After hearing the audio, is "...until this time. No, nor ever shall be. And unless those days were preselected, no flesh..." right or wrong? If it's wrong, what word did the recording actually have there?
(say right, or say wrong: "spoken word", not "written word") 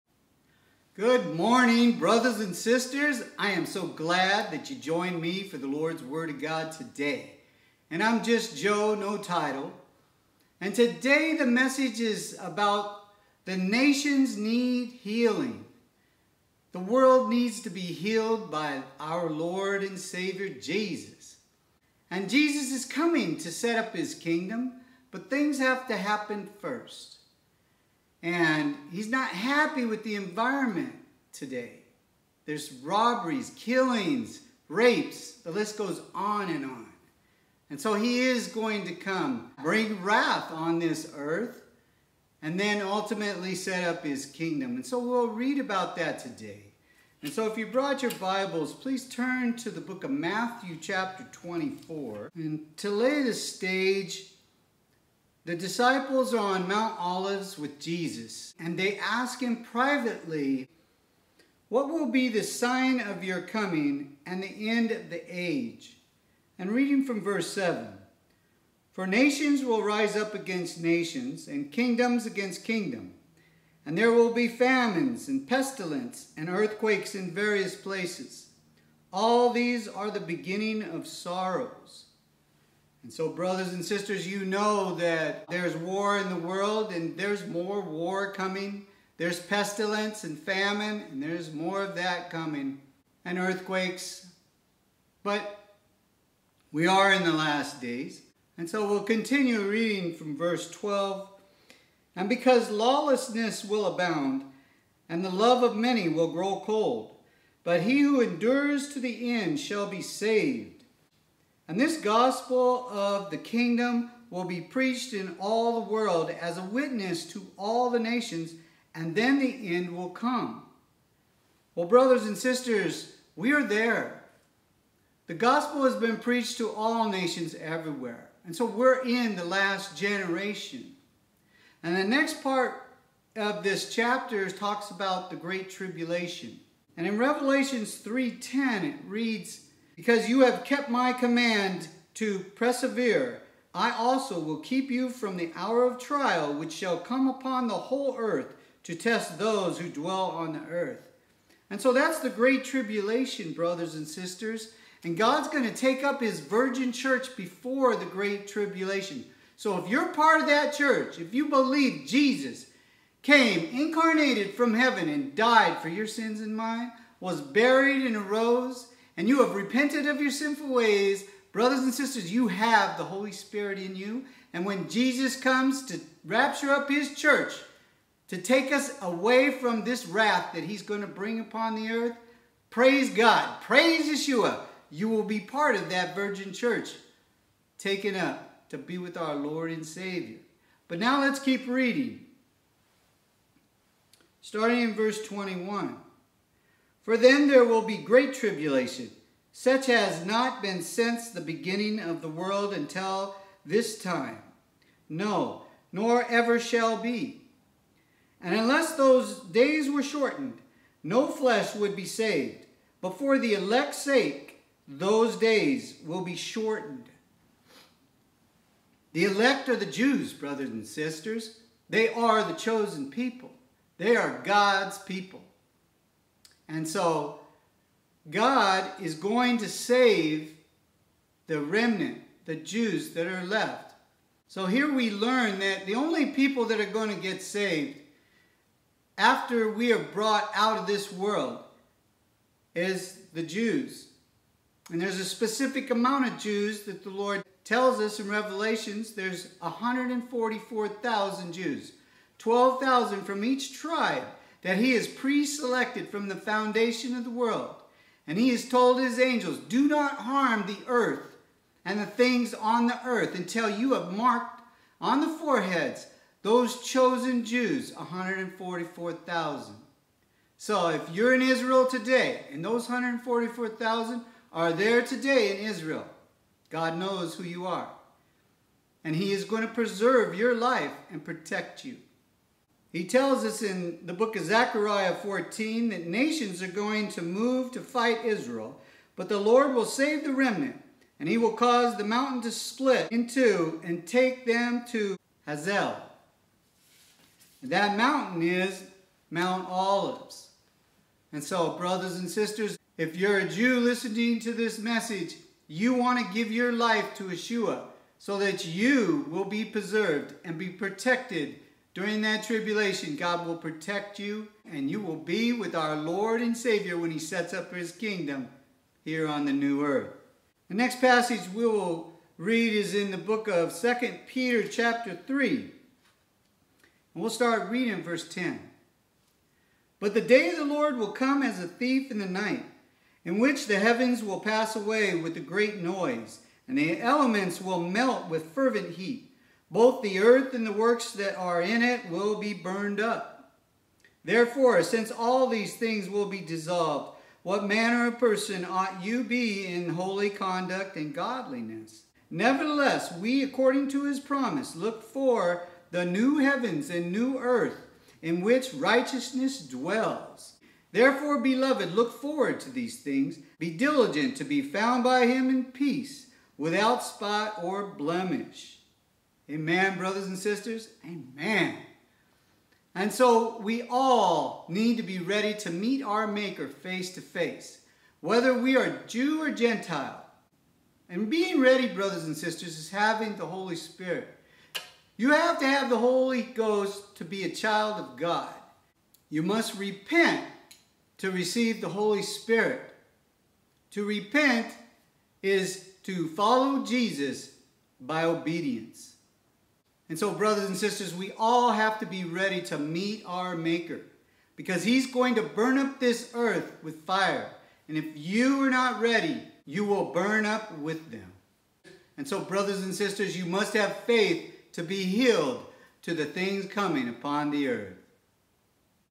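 wrong: "shortened", not "preselected".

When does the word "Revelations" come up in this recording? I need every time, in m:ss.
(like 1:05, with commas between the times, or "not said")
2:17, 4:08.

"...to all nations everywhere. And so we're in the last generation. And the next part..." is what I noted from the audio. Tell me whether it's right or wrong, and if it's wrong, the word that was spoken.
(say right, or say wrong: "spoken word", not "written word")
right.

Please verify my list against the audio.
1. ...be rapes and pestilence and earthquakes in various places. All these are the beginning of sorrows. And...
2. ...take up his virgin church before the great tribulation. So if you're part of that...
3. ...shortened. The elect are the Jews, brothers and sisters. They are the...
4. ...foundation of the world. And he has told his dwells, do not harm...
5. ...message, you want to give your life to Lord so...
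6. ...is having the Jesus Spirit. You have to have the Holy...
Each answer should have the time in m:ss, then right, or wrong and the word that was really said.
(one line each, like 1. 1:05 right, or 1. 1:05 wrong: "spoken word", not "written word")
1. 1:14 wrong: "famines", not "rapes"
2. 2:35 right
3. 3:36 right
4. 4:16 wrong: "angels", not "dwells"
5. 5:04 wrong: "Yeshua", not "Lord"
6. 6:22 wrong: "Holy", not "Jesus".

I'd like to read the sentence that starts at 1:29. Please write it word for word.
There's pestilence and famine, and there's more of that coming, and earthquakes.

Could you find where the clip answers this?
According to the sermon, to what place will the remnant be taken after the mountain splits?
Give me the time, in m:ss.
4:55.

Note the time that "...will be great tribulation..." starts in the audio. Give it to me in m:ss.
3:17.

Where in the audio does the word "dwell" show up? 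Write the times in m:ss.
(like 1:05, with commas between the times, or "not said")
2:29, 5:59.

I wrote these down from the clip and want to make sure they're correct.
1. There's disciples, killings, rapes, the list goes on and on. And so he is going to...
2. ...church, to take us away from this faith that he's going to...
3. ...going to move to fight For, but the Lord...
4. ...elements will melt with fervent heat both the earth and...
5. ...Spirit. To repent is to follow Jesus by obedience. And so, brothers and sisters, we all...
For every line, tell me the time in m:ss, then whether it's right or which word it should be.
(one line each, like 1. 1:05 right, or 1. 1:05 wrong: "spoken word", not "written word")
1. 0:32 wrong: "robberies", not "disciples"
2. 2:57 wrong: "wrath", not "faith"
3. 4:46 wrong: "Israel", not "For"
4. 5:37 right
5. 6:32 right.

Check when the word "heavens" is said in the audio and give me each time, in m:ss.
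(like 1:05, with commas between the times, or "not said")
2:44, 5:33, 5:56.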